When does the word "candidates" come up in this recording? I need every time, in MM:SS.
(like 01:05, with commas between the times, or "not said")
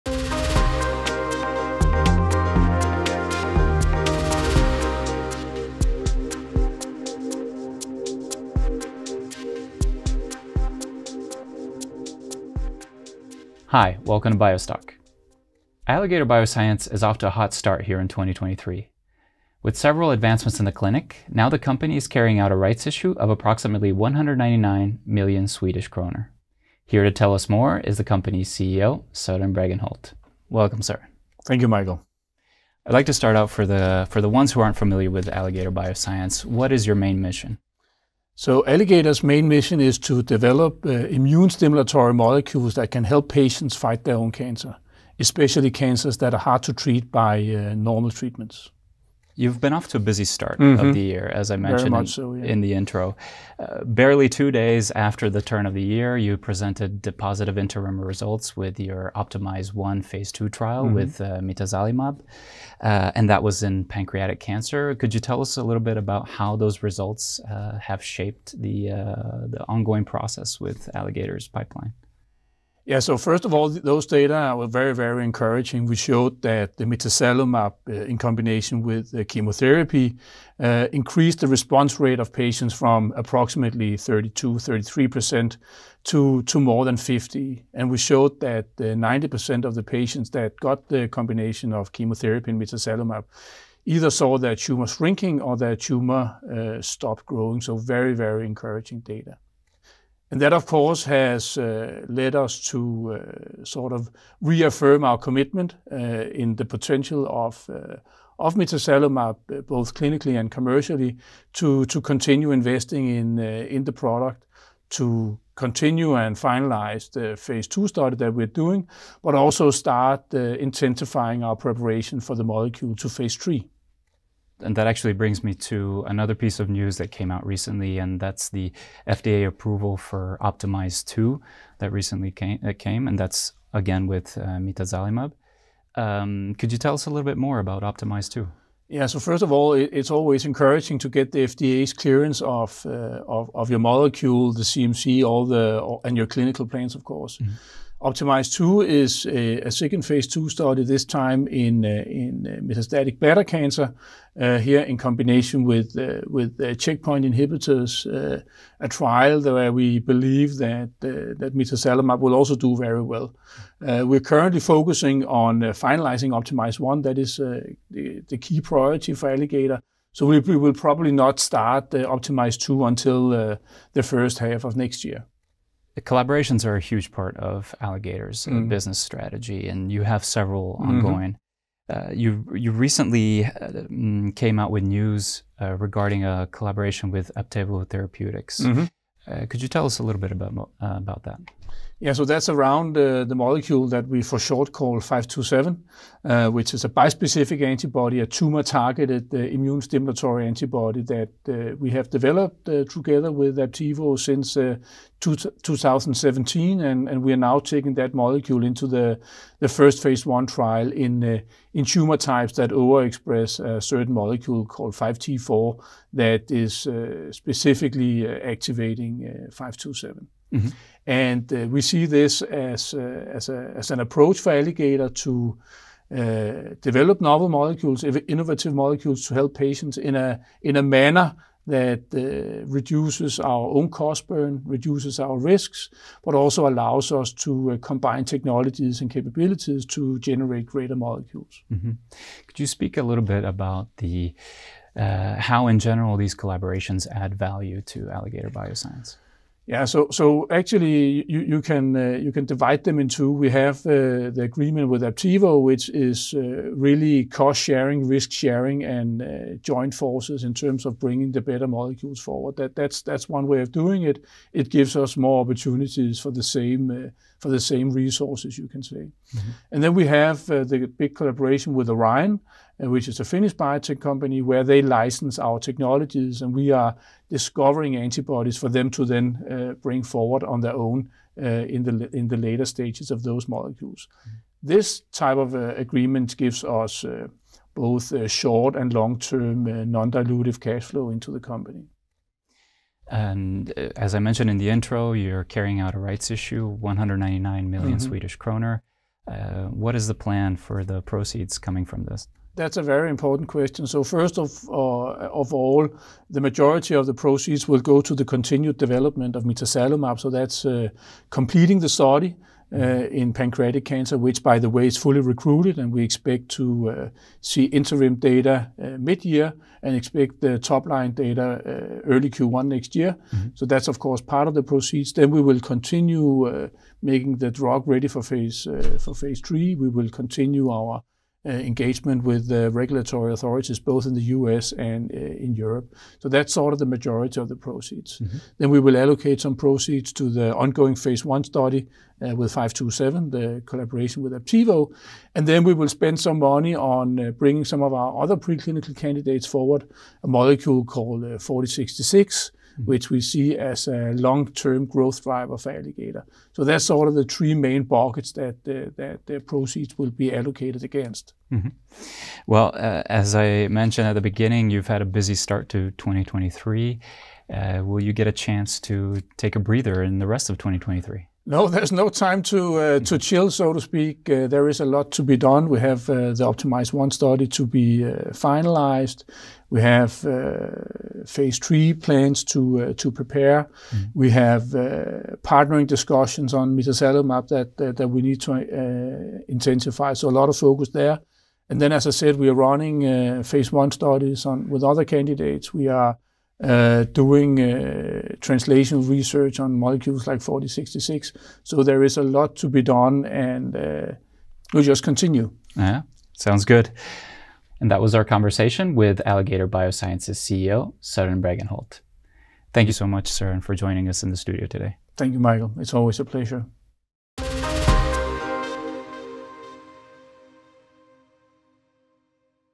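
05:48, 06:35.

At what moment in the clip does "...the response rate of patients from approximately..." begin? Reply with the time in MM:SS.
01:21.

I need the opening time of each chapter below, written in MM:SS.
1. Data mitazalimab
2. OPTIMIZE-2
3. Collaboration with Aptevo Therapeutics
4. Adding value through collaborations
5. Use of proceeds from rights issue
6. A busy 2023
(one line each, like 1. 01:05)
1. 00:49
2. 02:04
3. 02:55
4. 04:02
5. 04:53
6. 06:02.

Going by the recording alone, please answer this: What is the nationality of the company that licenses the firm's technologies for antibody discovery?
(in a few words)
Finnish.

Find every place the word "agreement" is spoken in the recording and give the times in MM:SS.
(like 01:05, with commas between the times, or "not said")
04:14, 04:45.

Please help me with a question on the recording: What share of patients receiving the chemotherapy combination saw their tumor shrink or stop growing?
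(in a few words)
90%.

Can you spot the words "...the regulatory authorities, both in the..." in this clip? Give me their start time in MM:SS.
05:32.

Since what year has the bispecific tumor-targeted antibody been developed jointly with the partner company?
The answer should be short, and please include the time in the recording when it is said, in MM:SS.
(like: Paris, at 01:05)
2017, at 03:25.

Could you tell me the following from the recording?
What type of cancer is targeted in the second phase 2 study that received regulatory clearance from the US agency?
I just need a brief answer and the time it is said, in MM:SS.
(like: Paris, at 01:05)
metastatic bladder cancer, at 02:32.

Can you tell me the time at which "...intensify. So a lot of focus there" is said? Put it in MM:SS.
06:29.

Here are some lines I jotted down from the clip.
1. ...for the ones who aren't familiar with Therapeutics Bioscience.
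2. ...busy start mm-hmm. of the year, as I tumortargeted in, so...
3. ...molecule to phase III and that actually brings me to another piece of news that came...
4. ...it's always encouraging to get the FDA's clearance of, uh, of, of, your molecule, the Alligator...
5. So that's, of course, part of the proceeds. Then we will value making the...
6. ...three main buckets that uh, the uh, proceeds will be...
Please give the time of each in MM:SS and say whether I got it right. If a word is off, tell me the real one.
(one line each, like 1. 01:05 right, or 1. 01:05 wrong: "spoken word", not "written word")
1. 00:34 wrong: "Alligator", not "Therapeutics"
2. 00:49 wrong: "mentioned", not "tumortargeted"
3. 02:02 right
4. 02:19 wrong: "CMC", not "Alligator"
5. 05:23 wrong: "continue", not "value"
6. 05:57 right.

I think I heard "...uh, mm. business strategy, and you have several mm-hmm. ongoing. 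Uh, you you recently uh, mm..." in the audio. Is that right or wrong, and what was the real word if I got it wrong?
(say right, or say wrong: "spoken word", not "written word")
right.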